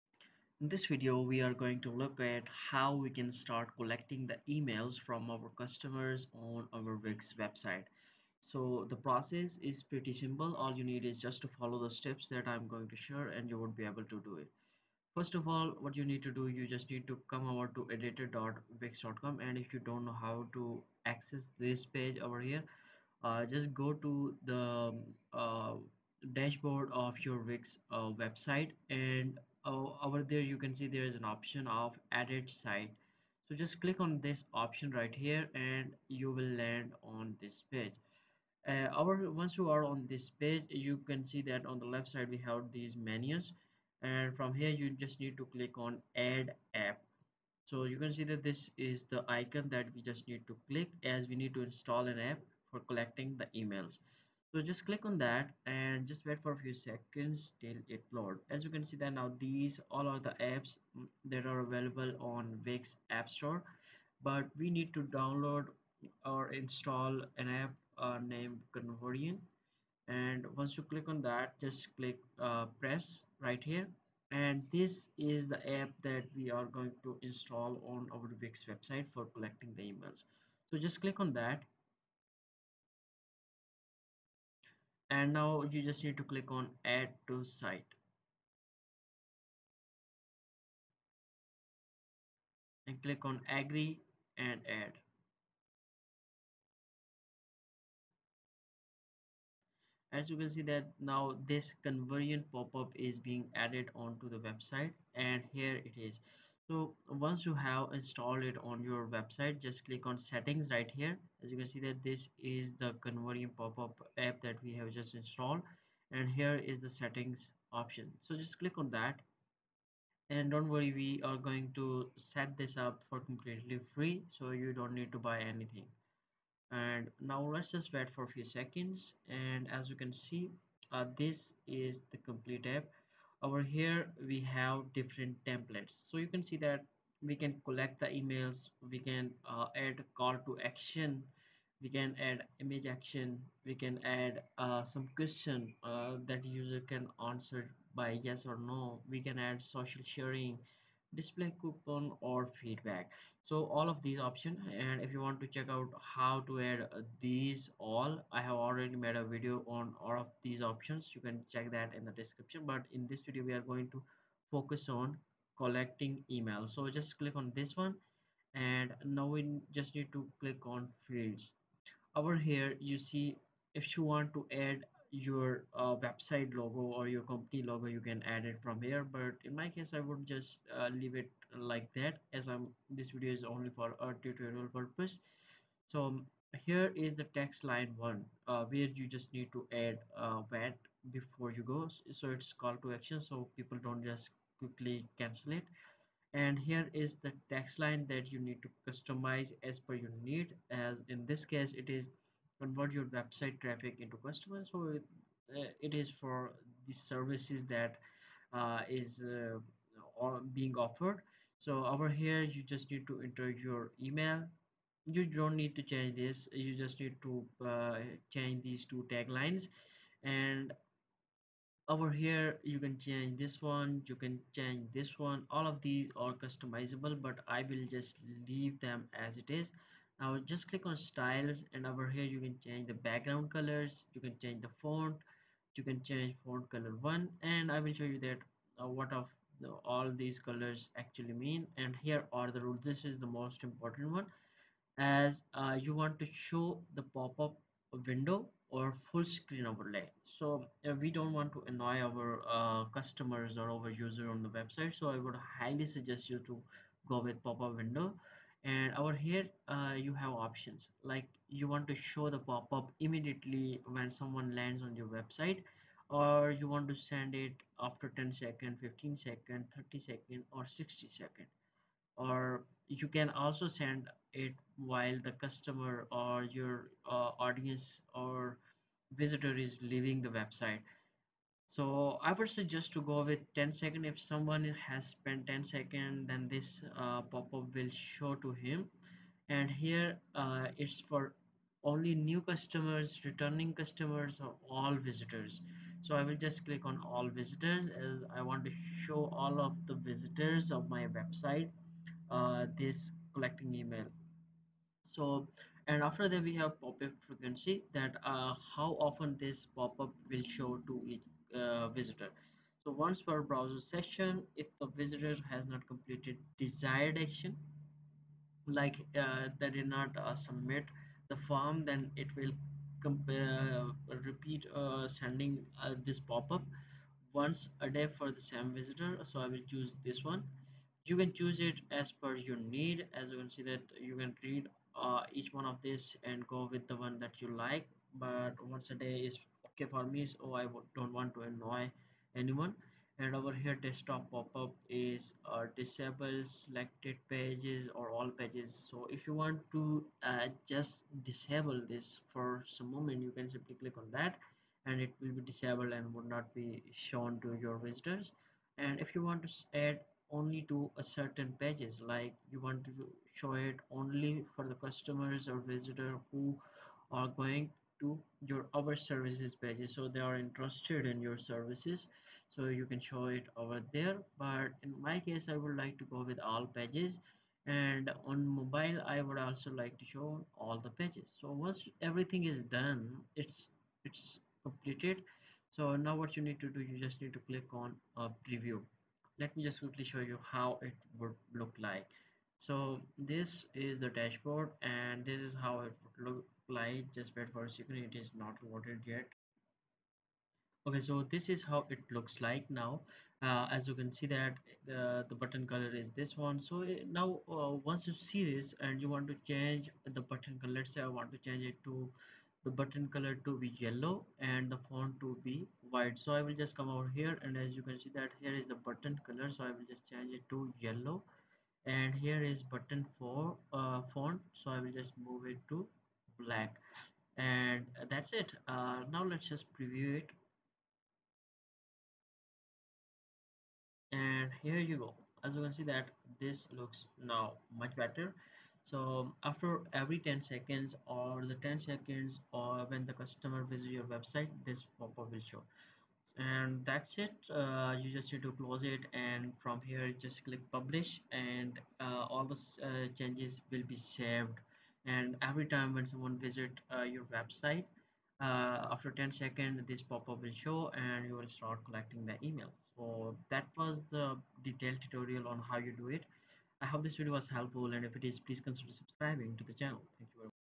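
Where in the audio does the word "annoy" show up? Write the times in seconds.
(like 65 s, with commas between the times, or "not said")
251 s, 341 s.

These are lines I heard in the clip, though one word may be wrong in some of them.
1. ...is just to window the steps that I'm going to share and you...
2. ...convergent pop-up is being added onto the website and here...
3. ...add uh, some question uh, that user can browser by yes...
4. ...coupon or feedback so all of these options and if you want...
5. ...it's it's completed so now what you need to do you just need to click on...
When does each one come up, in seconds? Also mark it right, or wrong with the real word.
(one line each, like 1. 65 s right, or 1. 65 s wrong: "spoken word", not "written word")
1. 11 s wrong: "follow", not "window"
2. 101 s right
3. 144 s wrong: "answer", not "browser"
4. 151 s right
5. 383 s right.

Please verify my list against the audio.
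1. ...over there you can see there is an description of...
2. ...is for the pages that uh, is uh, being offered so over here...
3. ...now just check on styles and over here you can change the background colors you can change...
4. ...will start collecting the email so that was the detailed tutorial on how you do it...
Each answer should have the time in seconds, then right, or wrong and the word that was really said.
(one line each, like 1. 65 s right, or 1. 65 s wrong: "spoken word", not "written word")
1. 30 s wrong: "option", not "description"
2. 205 s wrong: "services", not "pages"
3. 230 s wrong: "click", not "check"
4. 461 s right.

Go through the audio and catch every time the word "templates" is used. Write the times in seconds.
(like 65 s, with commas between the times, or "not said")
135 s.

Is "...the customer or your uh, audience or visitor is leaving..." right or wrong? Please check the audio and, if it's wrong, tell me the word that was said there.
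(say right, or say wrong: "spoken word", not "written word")
right.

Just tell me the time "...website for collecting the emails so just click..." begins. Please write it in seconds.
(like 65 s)
78 s.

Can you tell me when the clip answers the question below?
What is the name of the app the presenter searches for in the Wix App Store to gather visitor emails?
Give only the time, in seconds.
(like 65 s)
68 s.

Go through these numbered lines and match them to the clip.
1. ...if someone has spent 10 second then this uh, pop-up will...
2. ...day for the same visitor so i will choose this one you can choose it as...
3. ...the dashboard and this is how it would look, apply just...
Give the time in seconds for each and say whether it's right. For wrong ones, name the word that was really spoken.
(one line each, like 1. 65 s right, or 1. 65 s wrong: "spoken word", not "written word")
1. 284 s right
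2. 327 s right
3. 393 s right.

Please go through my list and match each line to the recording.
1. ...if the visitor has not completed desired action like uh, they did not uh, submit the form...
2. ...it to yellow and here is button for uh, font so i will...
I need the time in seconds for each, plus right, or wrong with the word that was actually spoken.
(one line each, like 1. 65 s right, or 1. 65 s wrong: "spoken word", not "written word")
1. 314 s right
2. 420 s right.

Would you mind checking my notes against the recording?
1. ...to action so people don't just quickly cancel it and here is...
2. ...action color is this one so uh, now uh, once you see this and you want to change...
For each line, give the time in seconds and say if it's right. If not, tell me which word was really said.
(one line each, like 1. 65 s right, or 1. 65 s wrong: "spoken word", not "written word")
1. 192 s right
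2. 405 s wrong: "button", not "action".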